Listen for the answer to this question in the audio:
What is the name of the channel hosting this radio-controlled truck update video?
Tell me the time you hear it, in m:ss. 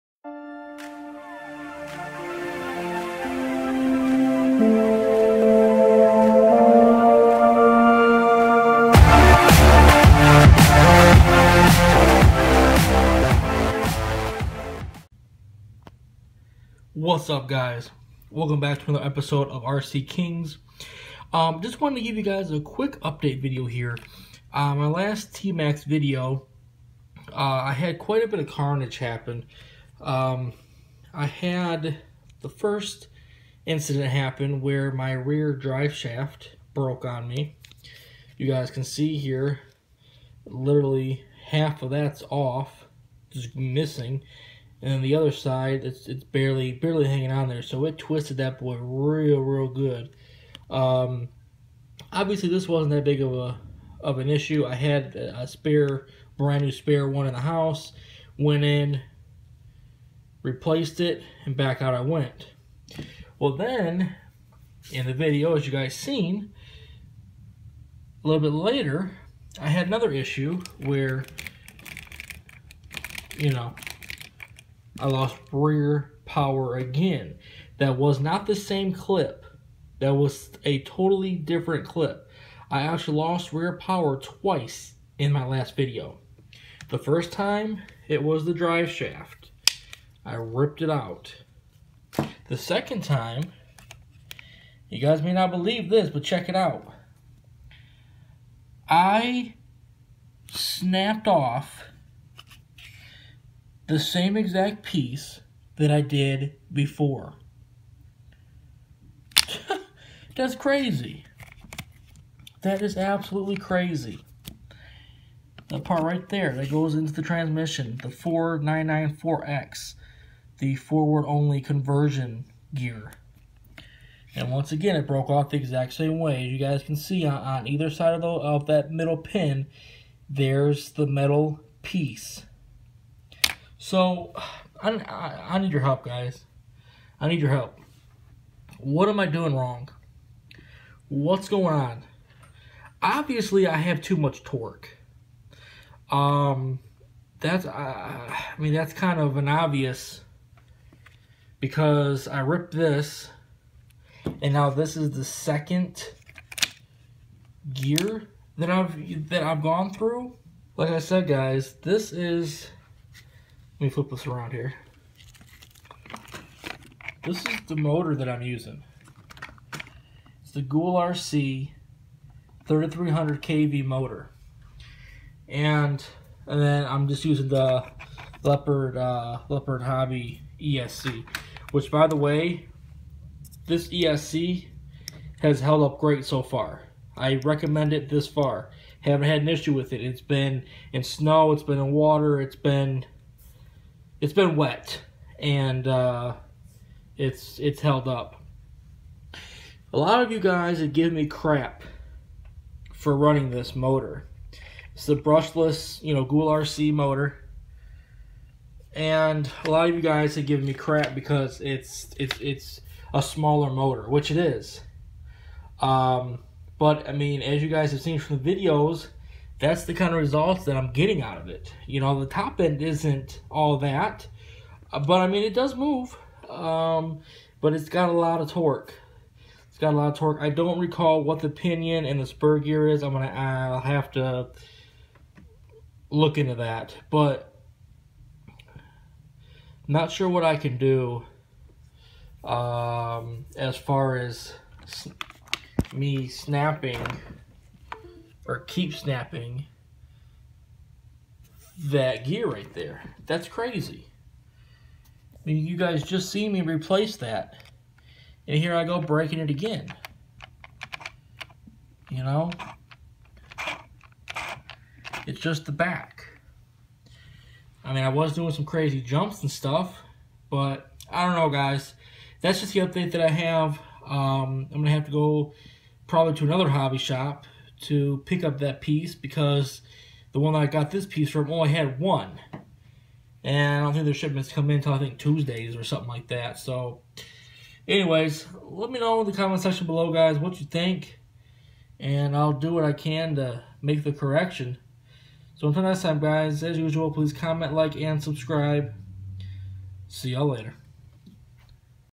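0:19.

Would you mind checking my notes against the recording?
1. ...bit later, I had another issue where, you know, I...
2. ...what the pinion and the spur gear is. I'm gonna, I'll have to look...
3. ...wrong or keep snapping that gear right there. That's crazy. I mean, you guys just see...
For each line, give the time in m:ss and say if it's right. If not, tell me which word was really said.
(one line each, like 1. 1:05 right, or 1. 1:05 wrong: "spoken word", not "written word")
1. 1:08 right
2. 3:51 right
3. 4:06 wrong: "snapping", not "wrong".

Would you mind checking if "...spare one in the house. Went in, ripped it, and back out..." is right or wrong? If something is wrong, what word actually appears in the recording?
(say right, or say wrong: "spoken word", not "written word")
wrong: "replaced", not "ripped".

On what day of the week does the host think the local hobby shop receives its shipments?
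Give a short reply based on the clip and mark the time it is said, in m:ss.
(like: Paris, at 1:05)
Tuesdays, at 4:45.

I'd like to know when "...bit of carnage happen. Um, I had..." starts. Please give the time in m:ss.
0:28.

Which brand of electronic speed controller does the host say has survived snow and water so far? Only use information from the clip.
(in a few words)
Leopard Hobby.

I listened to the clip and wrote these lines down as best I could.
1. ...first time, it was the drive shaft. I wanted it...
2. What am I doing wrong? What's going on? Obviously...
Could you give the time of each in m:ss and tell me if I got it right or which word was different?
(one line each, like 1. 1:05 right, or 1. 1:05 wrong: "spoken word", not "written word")
1. 1:26 wrong: "ripped", not "wanted"
2. 2:18 right.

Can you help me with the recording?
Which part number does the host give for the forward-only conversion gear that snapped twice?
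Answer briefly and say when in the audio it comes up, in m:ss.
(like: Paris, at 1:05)
4994X, at 1:58.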